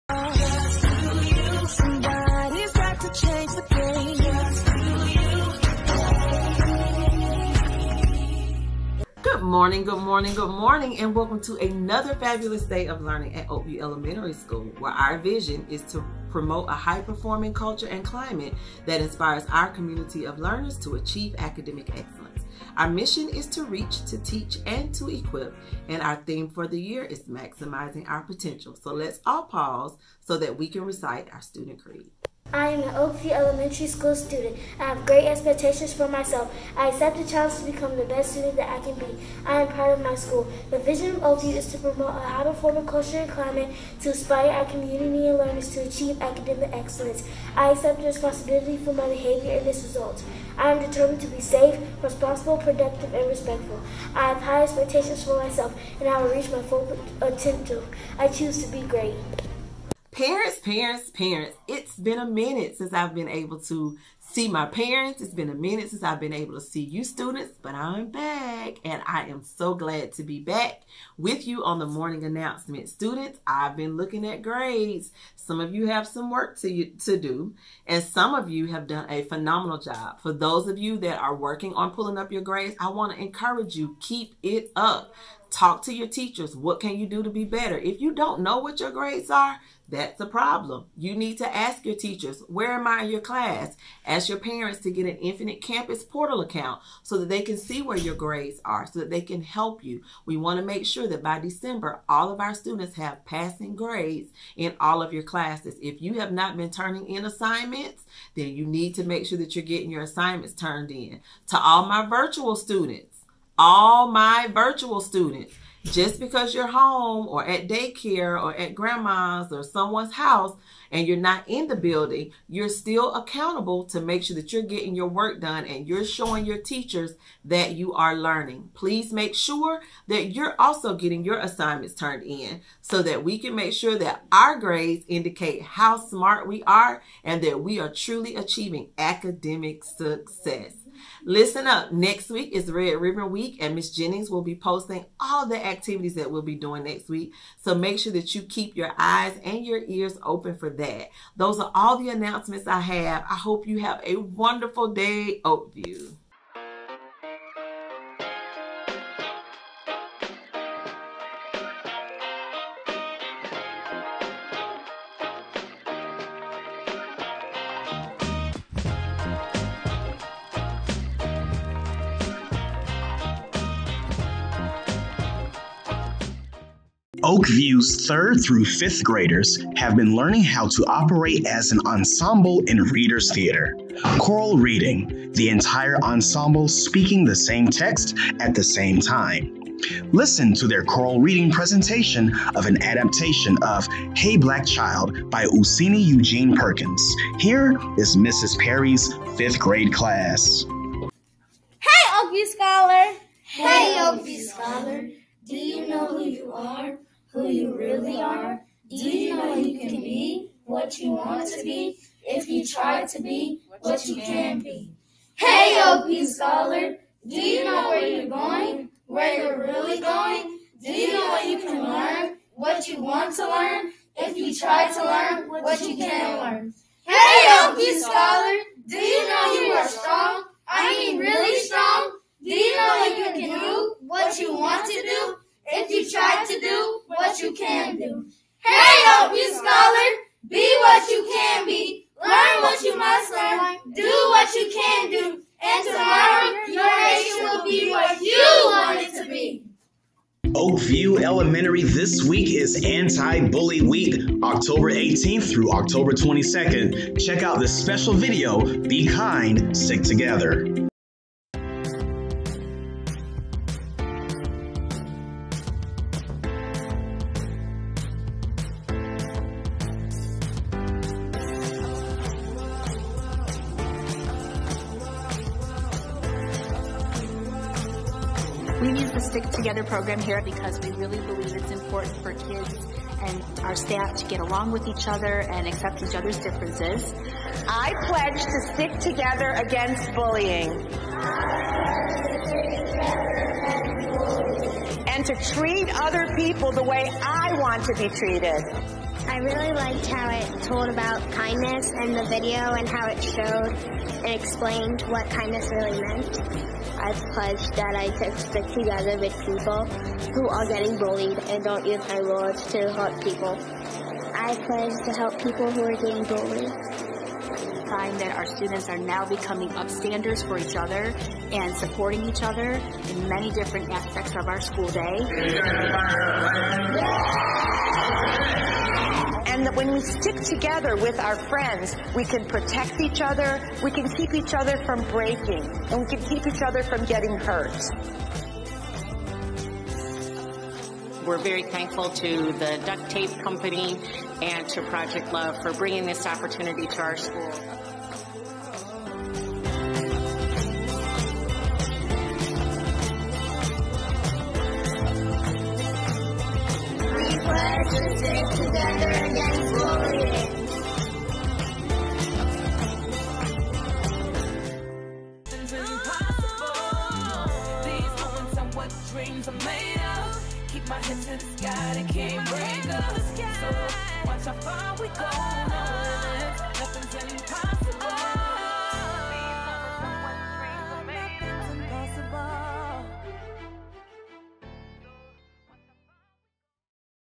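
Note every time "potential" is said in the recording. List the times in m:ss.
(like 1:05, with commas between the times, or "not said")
0:28, 0:57.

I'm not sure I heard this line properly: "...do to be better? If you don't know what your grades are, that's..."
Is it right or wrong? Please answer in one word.
right.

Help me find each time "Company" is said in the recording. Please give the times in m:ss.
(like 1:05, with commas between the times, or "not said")
5:43.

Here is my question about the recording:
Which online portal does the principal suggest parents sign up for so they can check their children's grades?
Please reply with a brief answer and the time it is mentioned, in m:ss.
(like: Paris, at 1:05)
Infinite Campus, at 1:35.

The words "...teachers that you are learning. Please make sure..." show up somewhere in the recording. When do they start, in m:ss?
2:06.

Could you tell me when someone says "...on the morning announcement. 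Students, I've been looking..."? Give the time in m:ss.
1:11.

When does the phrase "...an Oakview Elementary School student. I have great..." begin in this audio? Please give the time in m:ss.
0:32.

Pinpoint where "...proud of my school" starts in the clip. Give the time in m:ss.
0:39.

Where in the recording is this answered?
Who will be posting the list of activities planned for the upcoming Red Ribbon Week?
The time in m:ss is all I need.
2:23.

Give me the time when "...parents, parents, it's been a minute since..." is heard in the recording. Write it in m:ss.
1:00.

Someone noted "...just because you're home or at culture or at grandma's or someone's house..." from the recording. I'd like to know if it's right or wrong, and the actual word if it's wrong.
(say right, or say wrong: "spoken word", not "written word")
wrong: "daycare", not "culture".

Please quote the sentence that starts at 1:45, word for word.
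If you have not been turning in assignments, then you need to make sure that you're getting your assignments turned in.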